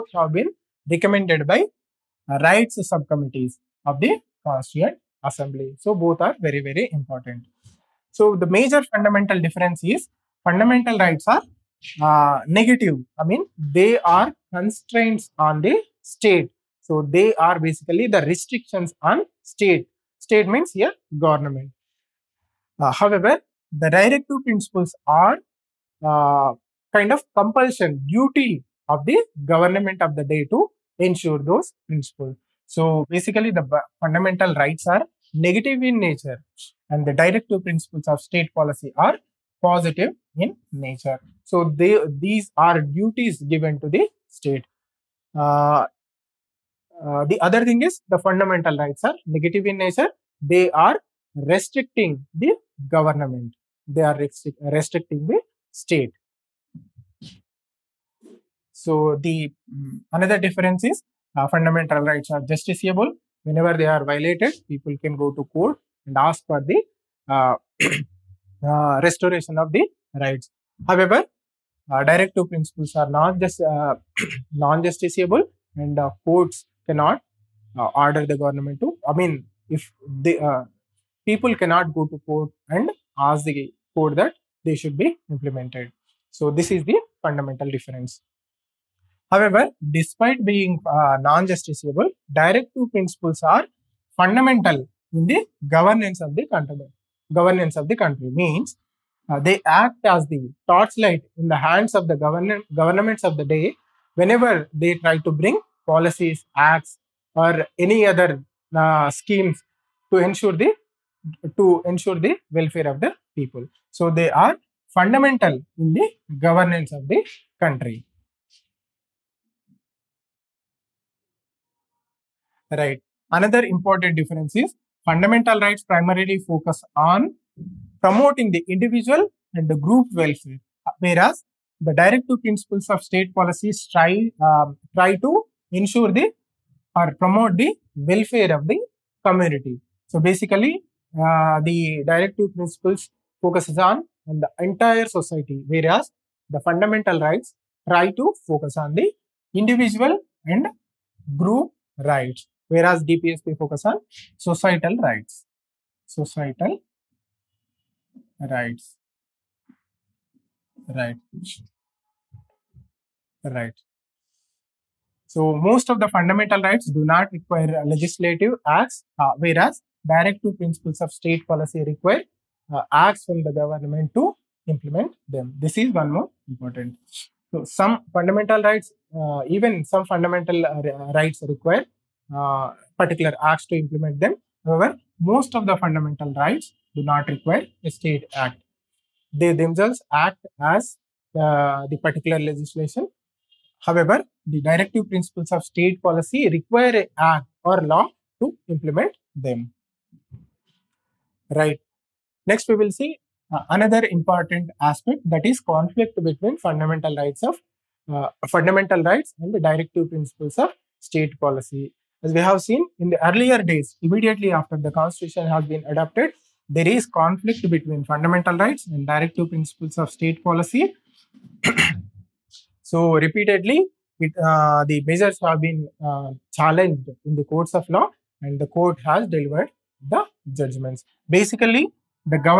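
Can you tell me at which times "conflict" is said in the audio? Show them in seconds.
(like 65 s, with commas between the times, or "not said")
205 s, 217 s.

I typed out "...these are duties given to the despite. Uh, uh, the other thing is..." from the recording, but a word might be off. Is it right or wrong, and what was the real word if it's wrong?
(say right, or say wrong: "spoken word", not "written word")
wrong: "state", not "despite".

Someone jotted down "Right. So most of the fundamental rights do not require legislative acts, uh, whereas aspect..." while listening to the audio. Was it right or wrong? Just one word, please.
wrong.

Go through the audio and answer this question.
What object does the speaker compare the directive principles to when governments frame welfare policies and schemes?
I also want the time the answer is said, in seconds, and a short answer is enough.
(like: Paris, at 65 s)
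torchlight, at 100 s.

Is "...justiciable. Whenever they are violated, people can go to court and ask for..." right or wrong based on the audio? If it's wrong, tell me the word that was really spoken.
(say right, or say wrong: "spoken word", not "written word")
right.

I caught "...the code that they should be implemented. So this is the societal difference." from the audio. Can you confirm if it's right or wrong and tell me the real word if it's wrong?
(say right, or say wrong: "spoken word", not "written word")
wrong: "fundamental", not "societal".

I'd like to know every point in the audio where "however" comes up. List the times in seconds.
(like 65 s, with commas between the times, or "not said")
22 s, 70 s, 89 s, 184 s, 193 s.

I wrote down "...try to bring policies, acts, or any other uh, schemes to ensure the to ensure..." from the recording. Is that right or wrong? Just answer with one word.
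right.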